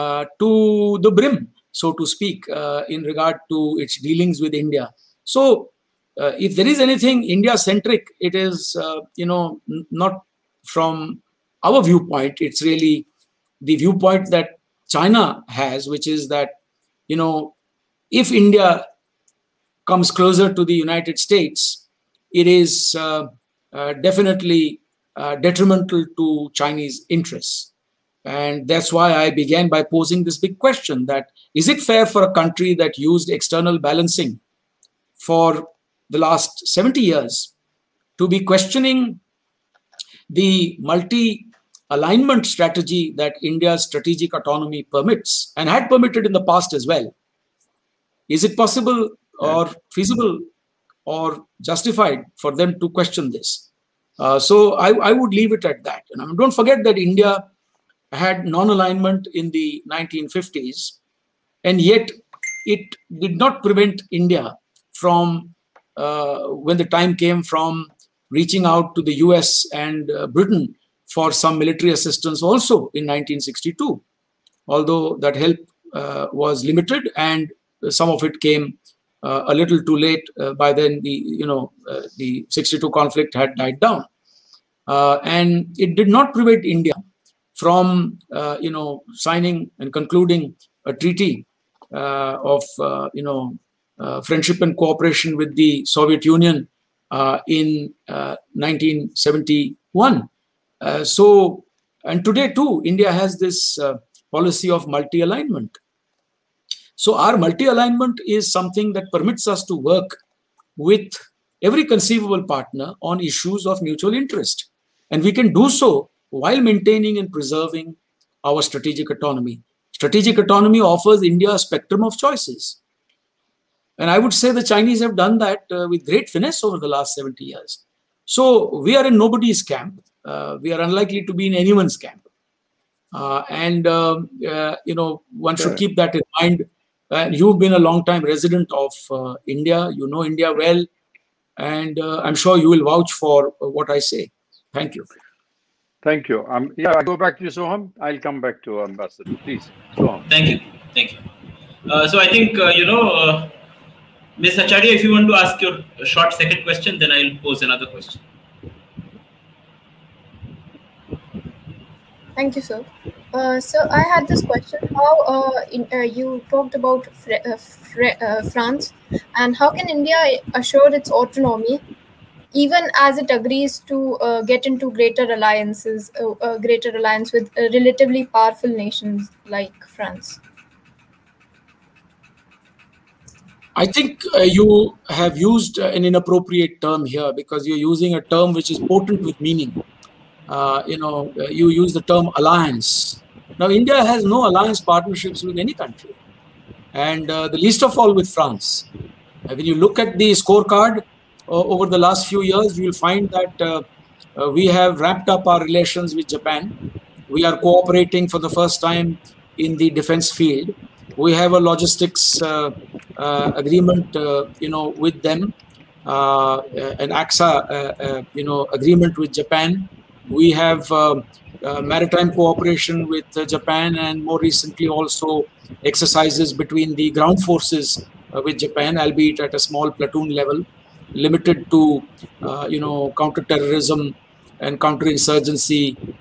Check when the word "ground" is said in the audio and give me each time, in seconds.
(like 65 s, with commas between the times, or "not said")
227 s.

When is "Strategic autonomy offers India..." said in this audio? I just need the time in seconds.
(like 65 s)
119 s.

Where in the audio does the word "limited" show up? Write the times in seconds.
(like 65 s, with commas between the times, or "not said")
76 s, 231 s.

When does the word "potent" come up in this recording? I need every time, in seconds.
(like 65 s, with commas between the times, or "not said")
188 s.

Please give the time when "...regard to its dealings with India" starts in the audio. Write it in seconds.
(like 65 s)
3 s.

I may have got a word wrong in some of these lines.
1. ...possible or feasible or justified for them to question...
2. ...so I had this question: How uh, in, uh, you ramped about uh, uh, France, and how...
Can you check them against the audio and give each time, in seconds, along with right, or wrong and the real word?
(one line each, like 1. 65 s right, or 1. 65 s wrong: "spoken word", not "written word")
1. 48 s right
2. 163 s wrong: "talked", not "ramped".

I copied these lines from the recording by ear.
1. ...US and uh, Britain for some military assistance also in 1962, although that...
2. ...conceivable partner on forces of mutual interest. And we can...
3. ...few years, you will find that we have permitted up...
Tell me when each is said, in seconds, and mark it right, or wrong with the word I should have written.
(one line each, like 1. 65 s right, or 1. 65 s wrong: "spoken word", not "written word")
1. 69 s right
2. 111 s wrong: "issues", not "forces"
3. 202 s wrong: "ramped", not "permitted".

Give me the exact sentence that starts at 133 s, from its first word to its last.
Uh, and, um, uh, you know, one sure.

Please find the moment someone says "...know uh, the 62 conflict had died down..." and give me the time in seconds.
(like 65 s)
81 s.